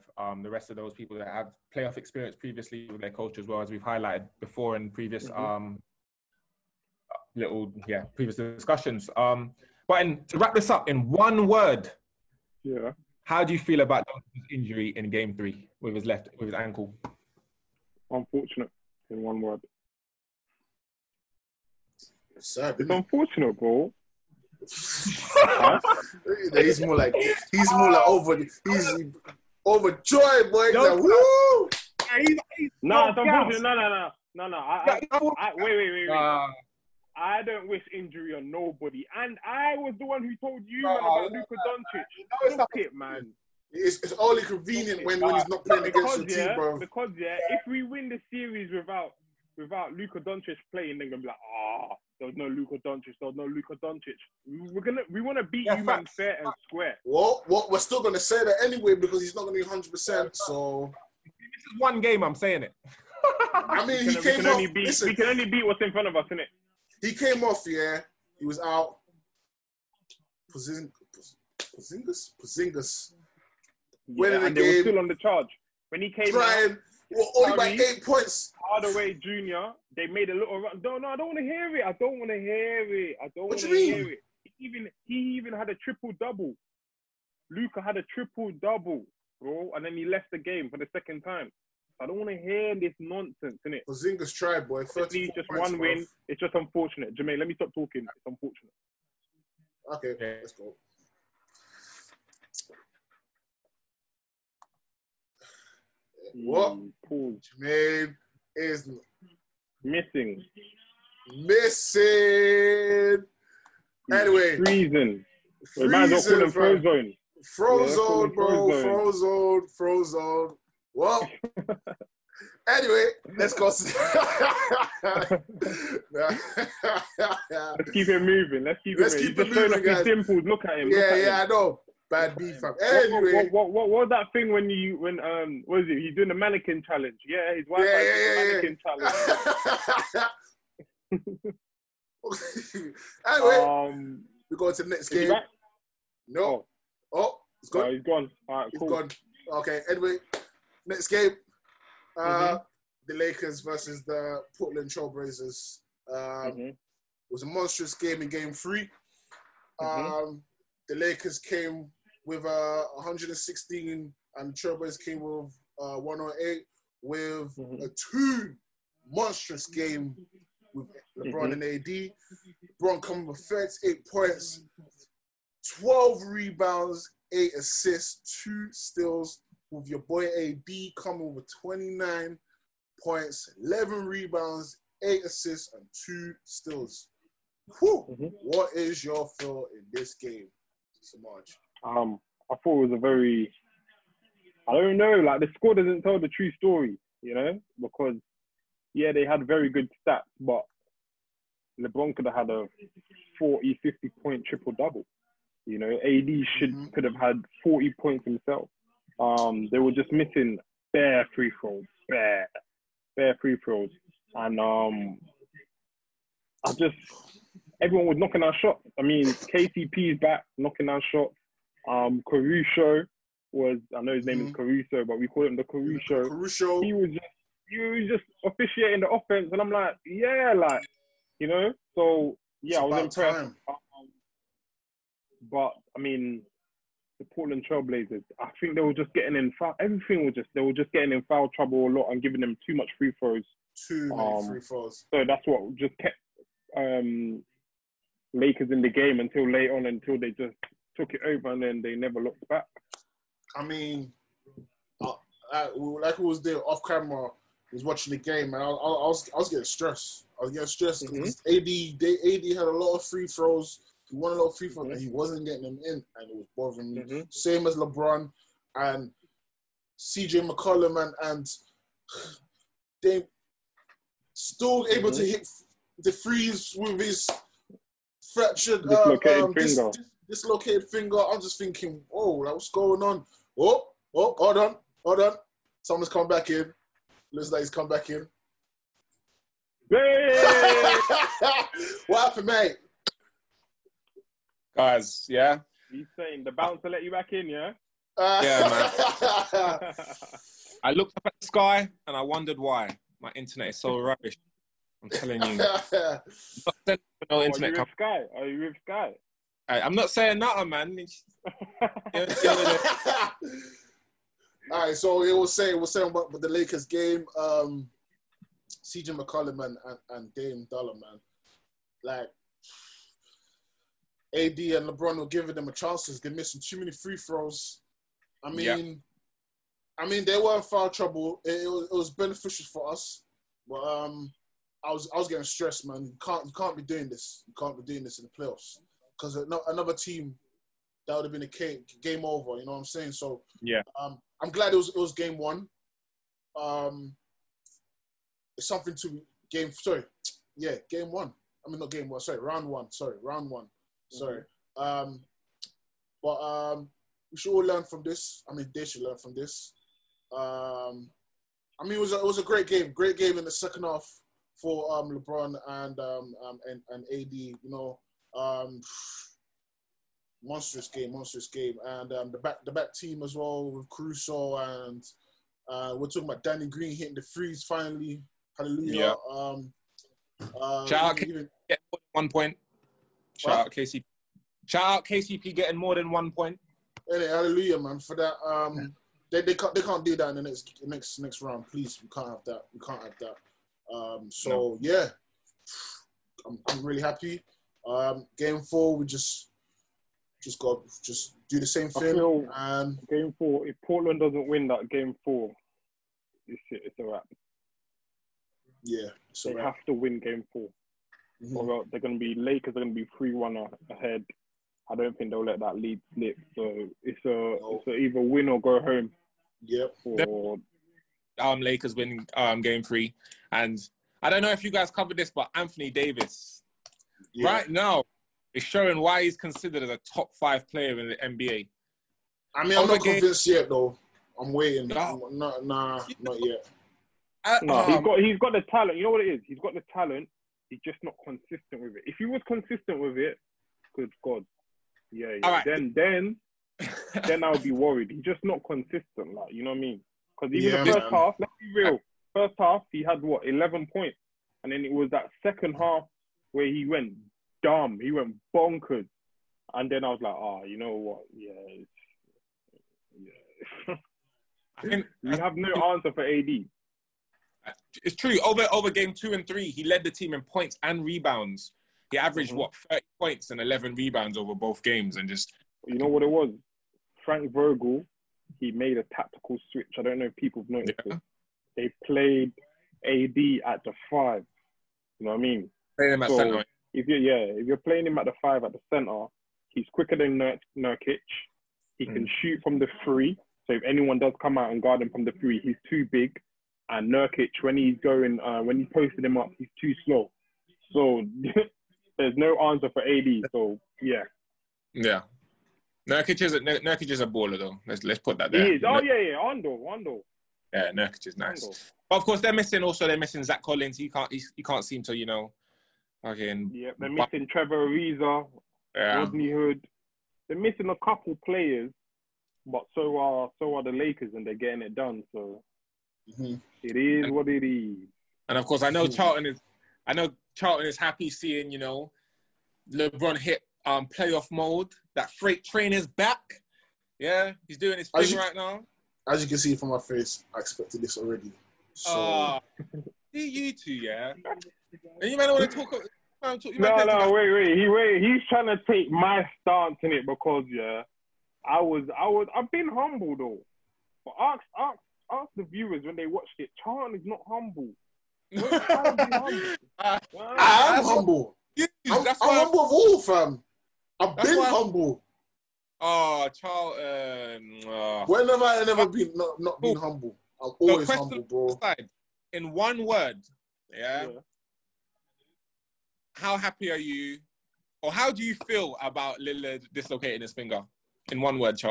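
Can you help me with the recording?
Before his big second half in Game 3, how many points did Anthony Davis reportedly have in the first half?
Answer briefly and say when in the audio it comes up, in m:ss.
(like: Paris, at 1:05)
11, at 7:33.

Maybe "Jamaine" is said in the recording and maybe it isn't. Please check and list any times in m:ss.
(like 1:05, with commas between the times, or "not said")
1:37, 1:47.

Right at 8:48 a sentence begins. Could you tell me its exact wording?
And of course, I know mm-hmm.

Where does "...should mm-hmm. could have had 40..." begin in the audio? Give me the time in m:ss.
3:26.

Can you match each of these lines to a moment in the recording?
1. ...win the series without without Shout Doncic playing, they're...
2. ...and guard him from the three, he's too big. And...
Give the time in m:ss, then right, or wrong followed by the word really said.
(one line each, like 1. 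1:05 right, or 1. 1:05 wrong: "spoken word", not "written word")
1. 0:47 wrong: "Luka", not "Shout"
2. 8:14 right.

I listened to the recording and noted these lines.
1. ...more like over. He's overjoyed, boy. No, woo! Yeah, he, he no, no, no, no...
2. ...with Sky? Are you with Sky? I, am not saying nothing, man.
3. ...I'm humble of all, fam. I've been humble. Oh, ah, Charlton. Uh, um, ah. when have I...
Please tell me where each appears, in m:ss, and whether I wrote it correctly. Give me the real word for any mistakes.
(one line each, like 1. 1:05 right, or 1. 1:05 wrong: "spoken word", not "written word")
1. 0:27 right
2. 5:07 right
3. 9:22 right.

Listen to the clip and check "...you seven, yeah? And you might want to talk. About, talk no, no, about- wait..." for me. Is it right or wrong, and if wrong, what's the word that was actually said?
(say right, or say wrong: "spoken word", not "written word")
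wrong: "two", not "seven".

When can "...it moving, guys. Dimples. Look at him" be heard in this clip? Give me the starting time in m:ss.
2:09.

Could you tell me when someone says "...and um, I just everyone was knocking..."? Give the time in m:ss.
3:34.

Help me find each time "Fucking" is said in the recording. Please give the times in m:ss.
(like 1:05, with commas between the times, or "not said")
8:36.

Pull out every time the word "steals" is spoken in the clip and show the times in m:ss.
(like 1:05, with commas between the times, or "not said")
2:58, 3:06.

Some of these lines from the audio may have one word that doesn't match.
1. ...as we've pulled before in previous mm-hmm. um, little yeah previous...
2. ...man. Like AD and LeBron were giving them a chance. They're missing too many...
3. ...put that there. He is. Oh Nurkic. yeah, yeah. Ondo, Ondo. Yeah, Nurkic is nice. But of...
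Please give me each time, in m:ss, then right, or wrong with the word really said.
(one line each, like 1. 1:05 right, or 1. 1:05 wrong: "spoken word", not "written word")
1. 0:03 wrong: "highlighted", not "pulled"
2. 5:20 right
3. 8:28 right.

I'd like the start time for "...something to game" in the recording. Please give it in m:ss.
5:48.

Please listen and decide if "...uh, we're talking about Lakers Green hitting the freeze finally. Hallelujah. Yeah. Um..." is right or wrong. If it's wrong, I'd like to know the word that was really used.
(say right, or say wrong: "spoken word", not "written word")
wrong: "Danny", not "Lakers".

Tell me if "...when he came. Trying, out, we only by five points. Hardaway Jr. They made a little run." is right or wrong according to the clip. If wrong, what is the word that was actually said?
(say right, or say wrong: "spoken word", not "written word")
wrong: "eight", not "five".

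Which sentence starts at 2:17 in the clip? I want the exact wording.
Yeah, his wife yeah, yeah, yeah, mannequin challenge.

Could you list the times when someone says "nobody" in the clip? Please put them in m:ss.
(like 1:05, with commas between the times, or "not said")
0:38.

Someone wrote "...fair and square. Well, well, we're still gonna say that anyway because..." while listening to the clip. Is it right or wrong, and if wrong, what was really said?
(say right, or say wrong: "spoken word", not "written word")
right.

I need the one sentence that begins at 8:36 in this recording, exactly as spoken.
Yeah, they're missing Trevor Ariza, yeah.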